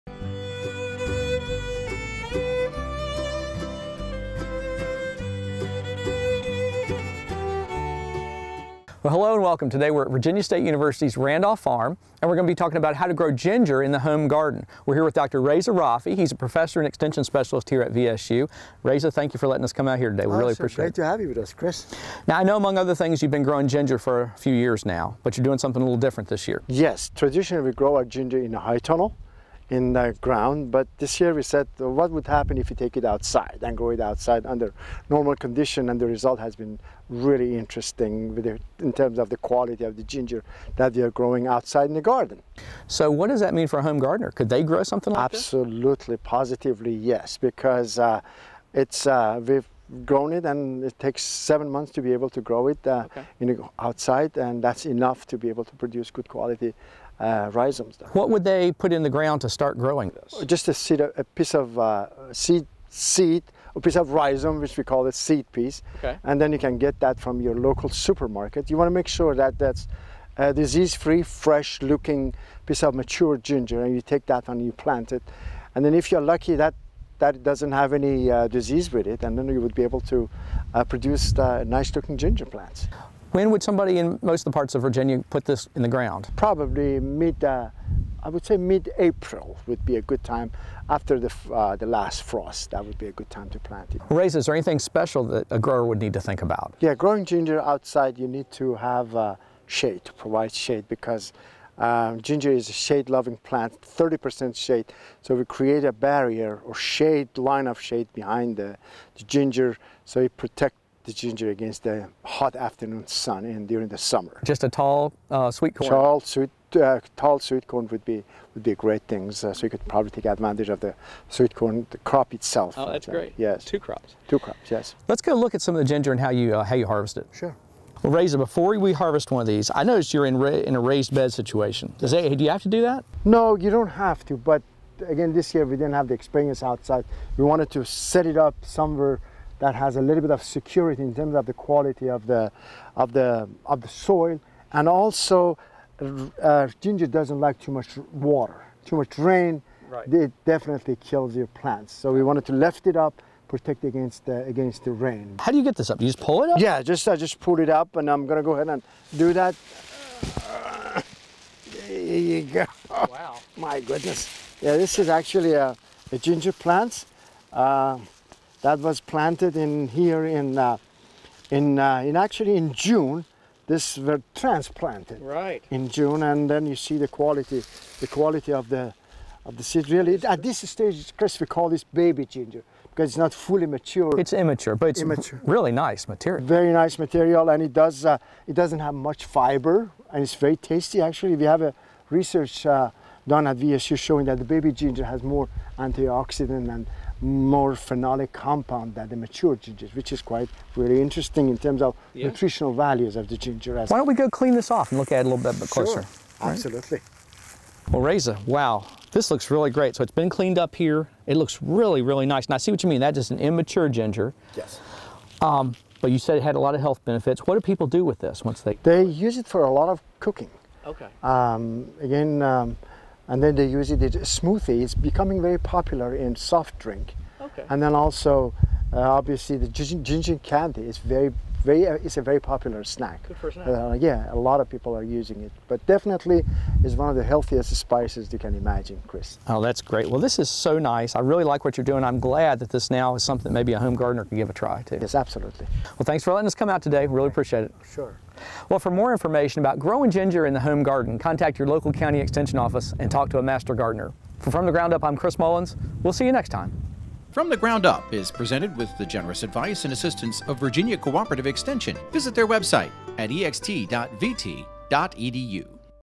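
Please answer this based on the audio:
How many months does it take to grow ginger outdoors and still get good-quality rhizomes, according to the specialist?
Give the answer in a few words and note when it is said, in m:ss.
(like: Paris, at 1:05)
7, at 0:51.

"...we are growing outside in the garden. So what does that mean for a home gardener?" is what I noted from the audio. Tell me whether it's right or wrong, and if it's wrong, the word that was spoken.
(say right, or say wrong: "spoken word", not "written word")
right.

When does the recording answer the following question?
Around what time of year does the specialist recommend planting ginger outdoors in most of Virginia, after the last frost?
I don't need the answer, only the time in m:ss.
1:28.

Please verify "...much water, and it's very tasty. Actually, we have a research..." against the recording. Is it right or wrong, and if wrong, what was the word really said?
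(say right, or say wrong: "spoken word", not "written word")
wrong: "fiber", not "water".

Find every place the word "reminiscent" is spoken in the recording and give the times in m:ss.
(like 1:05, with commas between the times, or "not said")
not said.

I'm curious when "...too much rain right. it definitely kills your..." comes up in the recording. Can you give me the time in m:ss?
2:28.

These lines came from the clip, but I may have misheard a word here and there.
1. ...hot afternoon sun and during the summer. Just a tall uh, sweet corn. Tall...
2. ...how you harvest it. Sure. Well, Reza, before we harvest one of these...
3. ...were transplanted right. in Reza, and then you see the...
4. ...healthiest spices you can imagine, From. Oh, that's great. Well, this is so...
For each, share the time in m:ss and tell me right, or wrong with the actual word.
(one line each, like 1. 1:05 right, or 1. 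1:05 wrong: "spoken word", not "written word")
1. 1:52 right
2. 2:06 right
3. 2:53 wrong: "June", not "Reza"
4. 3:57 wrong: "Chris", not "From".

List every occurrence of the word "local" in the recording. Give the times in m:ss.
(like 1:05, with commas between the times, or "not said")
1:07, 4:11.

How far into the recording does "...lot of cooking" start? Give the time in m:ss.
3:39.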